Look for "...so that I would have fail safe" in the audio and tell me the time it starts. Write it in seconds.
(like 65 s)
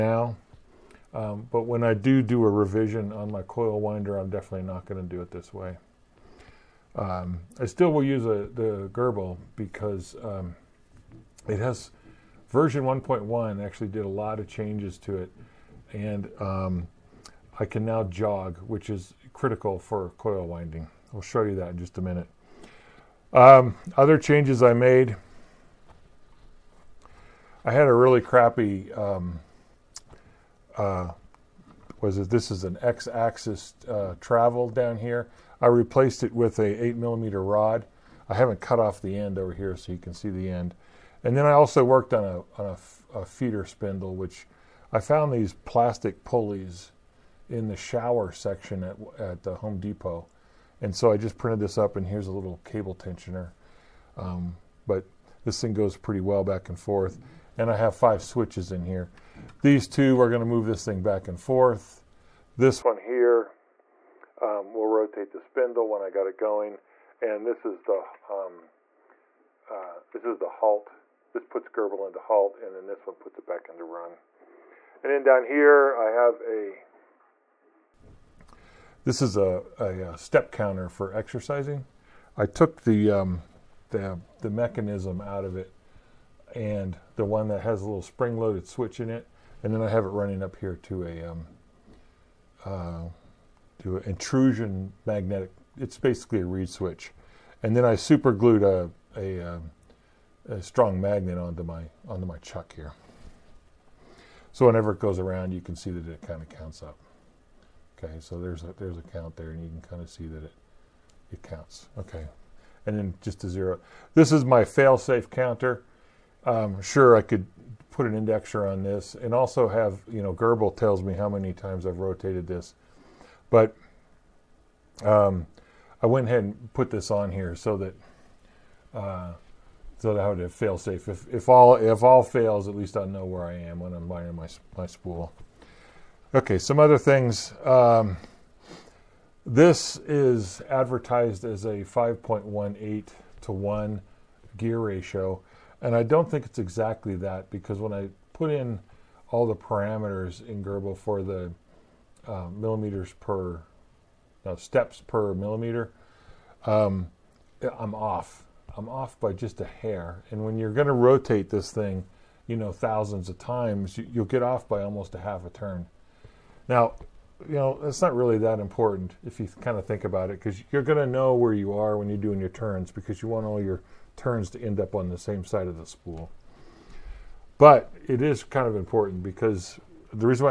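129 s.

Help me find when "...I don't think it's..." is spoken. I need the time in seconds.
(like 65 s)
145 s.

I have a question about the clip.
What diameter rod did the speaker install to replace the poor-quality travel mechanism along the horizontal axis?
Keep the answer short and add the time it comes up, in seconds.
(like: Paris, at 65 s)
8 millimeter, at 36 s.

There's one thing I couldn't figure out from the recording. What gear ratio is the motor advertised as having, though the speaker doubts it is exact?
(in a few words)
5.18 to 1.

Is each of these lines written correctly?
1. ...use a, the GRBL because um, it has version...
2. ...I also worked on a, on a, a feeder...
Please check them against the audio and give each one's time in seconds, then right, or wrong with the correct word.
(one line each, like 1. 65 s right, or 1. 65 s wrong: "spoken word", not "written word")
1. 8 s right
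2. 41 s right.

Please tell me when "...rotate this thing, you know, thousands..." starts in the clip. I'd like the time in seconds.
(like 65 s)
160 s.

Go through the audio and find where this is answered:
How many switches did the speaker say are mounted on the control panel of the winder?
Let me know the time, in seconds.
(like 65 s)
57 s.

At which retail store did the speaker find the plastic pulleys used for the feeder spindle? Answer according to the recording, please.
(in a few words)
Home Depot.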